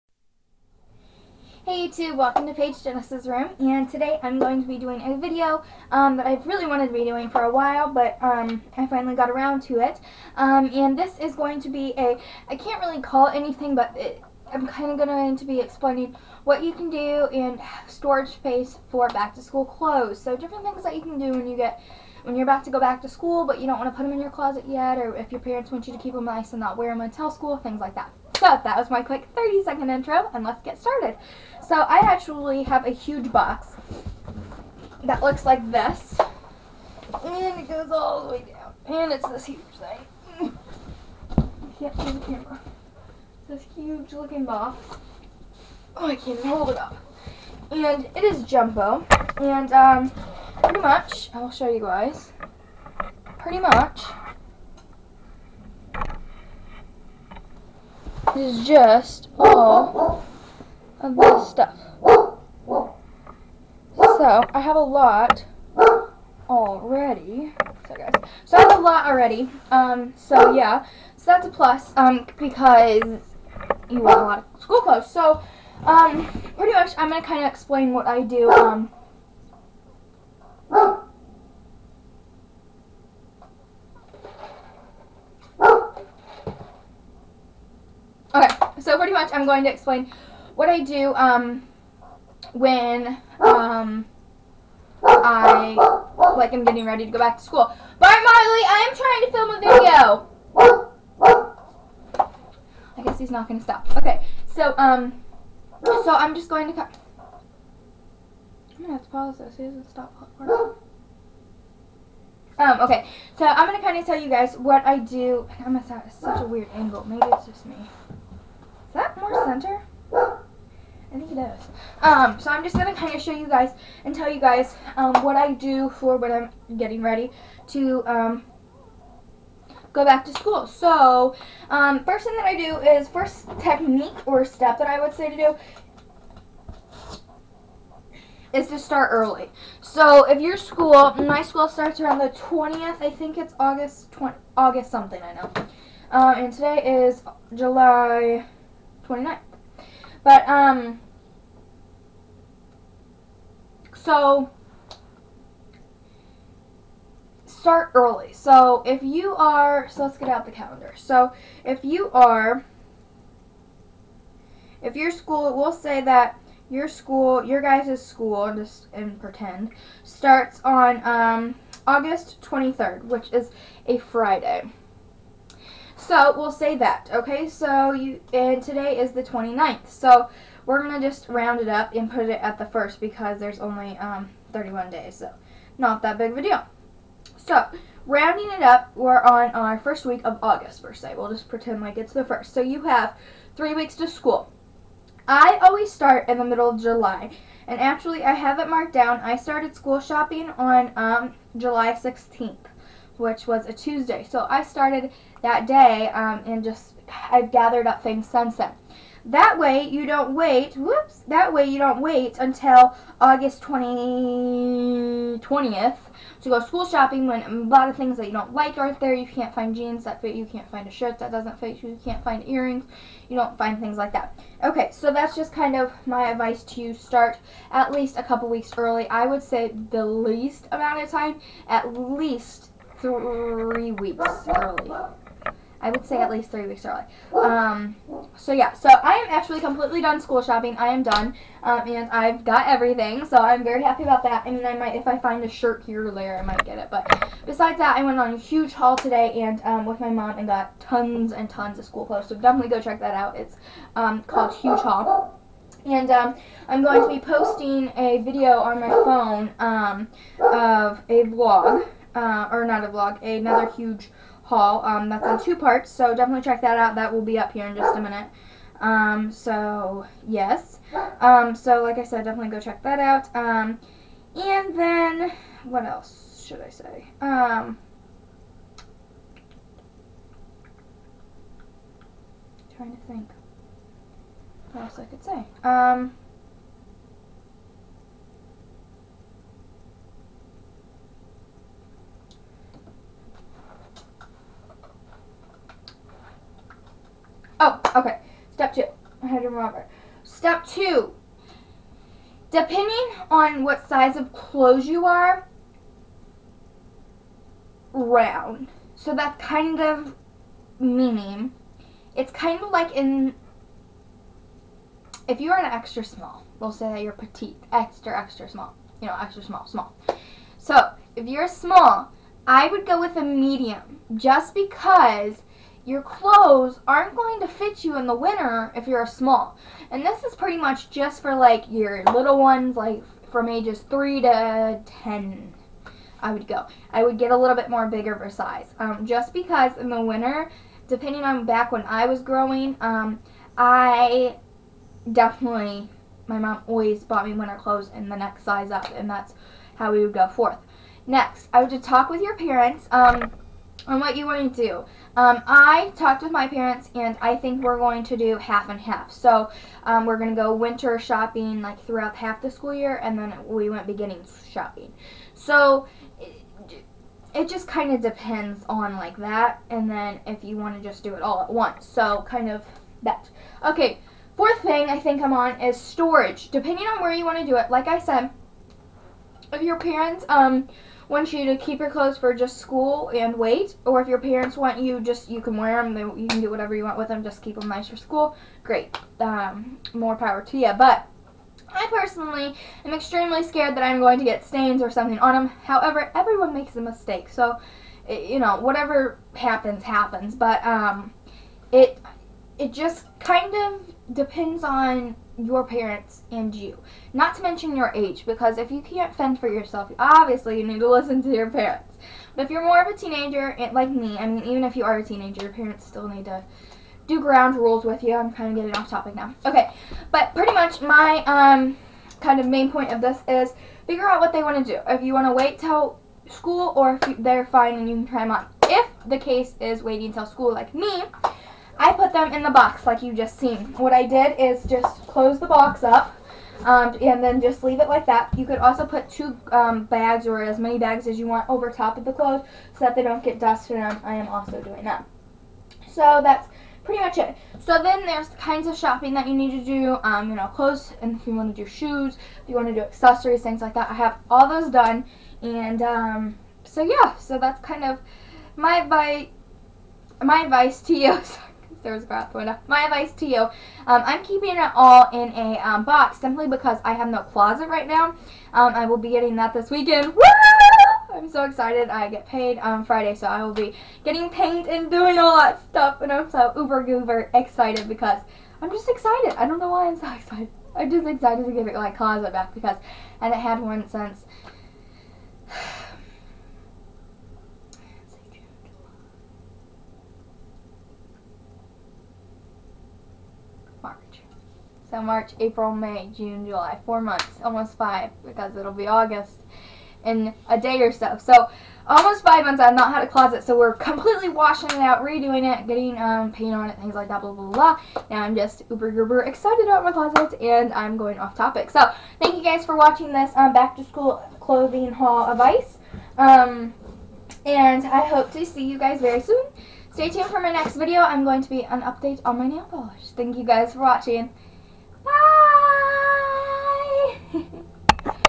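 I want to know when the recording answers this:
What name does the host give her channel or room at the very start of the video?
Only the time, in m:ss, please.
0:02.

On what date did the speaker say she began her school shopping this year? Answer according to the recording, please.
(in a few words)
July 16th.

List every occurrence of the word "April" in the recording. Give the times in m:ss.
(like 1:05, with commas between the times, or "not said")
8:15.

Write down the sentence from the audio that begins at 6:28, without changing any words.
Great, um, more power to you.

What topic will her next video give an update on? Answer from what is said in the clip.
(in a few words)
Nail polish.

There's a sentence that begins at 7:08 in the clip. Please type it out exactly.
If the case is waiting till school like me, I put them in the box like you just seen.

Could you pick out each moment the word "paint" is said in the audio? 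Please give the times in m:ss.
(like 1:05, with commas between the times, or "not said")
7:54, 8:26.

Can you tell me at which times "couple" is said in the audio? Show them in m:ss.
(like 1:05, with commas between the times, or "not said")
3:48.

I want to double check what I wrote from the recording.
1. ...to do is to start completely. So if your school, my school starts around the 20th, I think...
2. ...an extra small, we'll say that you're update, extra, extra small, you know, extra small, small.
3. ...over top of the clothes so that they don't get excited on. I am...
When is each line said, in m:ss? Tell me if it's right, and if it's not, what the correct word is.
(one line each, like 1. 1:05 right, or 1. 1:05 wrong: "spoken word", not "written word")
1. 2:15 wrong: "early", not "completely"
2. 5:15 wrong: "petite", not "update"
3. 7:21 wrong: "dusted", not "excited".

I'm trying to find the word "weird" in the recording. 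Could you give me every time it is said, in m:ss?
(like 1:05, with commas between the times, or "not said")
1:56.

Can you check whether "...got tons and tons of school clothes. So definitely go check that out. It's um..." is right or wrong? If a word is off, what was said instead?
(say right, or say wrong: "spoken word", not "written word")
right.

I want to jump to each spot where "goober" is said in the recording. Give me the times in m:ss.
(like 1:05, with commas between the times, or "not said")
7:56.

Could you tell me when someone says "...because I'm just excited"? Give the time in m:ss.
7:57.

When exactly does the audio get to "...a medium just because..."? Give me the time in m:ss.
5:23.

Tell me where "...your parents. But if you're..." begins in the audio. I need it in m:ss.
6:51.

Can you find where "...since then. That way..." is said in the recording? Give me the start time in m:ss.
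3:28.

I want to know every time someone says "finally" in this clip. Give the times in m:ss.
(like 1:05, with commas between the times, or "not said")
0:08.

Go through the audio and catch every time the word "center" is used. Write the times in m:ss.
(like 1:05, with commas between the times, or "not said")
1:59.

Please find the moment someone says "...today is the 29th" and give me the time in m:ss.
2:58.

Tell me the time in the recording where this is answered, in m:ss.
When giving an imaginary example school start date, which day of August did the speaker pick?
2:51.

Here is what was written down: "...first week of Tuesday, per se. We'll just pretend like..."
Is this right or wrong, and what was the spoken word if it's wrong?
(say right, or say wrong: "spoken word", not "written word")
wrong: "August", not "Tuesday".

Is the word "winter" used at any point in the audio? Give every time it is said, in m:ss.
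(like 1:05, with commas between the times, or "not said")
5:28, 5:40, 5:47, 6:00.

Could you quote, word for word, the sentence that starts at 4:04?
I mean, I might, if I find a shirt here or there, I might get it.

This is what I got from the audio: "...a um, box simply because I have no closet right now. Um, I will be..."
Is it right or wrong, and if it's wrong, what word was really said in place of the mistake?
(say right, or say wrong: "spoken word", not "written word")
right.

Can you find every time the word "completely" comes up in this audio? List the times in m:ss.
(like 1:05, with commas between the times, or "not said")
3:59, 8:23.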